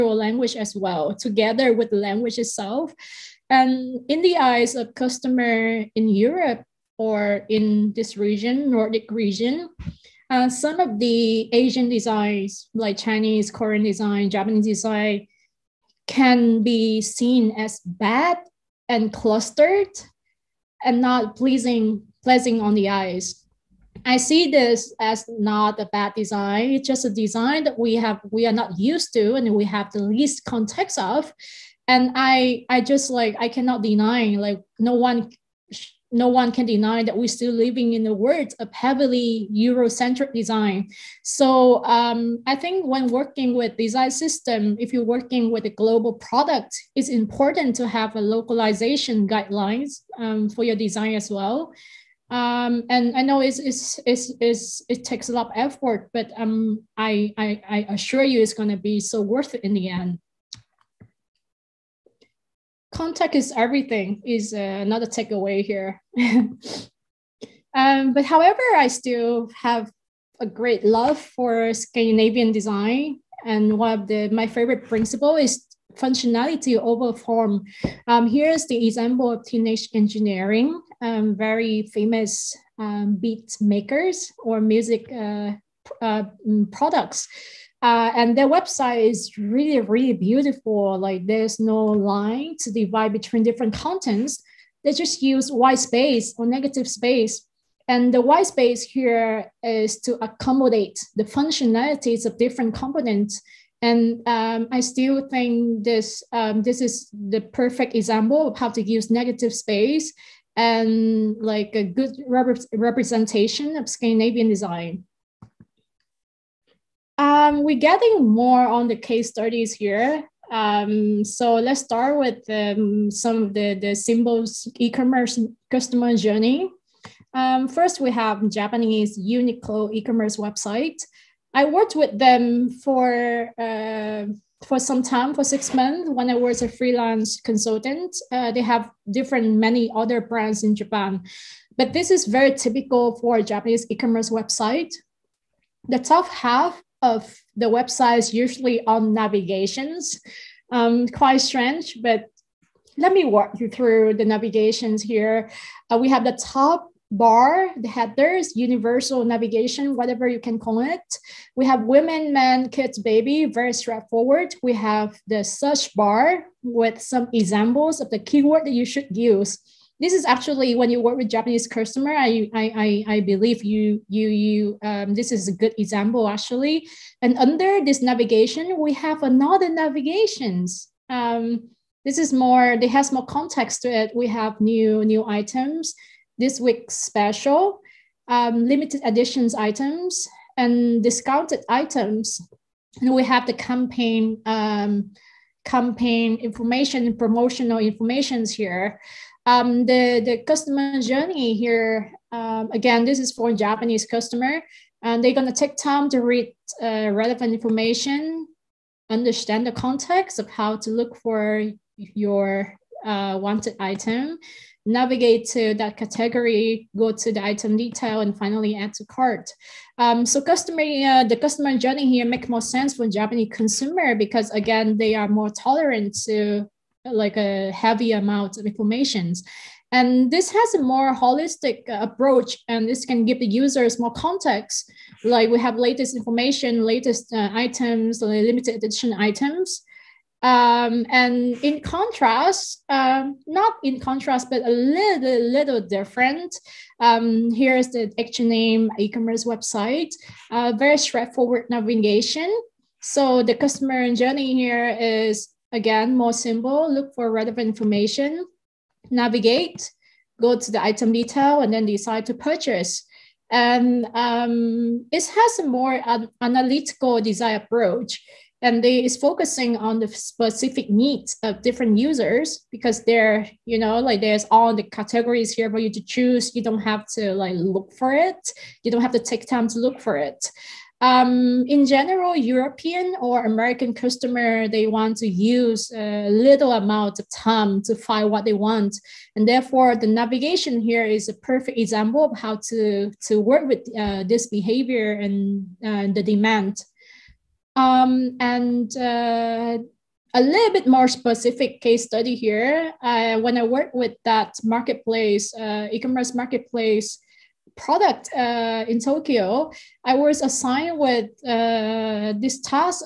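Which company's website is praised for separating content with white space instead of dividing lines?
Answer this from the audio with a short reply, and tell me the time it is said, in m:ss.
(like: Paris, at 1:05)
Teenage Engineering, at 1:19.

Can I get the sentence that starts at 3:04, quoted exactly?
We have new new items, this week's special, um, limited editions items, and discounted items.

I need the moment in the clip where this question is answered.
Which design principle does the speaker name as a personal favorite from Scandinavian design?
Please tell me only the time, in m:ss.
1:15.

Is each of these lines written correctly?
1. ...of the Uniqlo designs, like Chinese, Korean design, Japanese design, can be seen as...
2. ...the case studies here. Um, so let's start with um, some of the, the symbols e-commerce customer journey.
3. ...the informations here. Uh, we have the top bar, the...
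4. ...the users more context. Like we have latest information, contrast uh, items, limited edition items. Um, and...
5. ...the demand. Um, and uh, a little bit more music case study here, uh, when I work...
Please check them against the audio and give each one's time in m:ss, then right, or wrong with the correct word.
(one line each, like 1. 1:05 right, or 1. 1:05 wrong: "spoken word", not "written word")
1. 0:10 wrong: "Asian", not "Uniqlo"
2. 1:58 right
3. 2:34 wrong: "navigations", not "informations"
4. 3:53 wrong: "latest", not "contrast"
5. 4:56 wrong: "specific", not "music".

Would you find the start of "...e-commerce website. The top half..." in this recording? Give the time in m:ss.
2:23.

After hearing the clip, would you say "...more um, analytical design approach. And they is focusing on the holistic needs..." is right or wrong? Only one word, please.
wrong.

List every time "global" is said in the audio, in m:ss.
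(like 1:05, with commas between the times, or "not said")
0:45.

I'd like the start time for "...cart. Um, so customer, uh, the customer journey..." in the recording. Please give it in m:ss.
3:39.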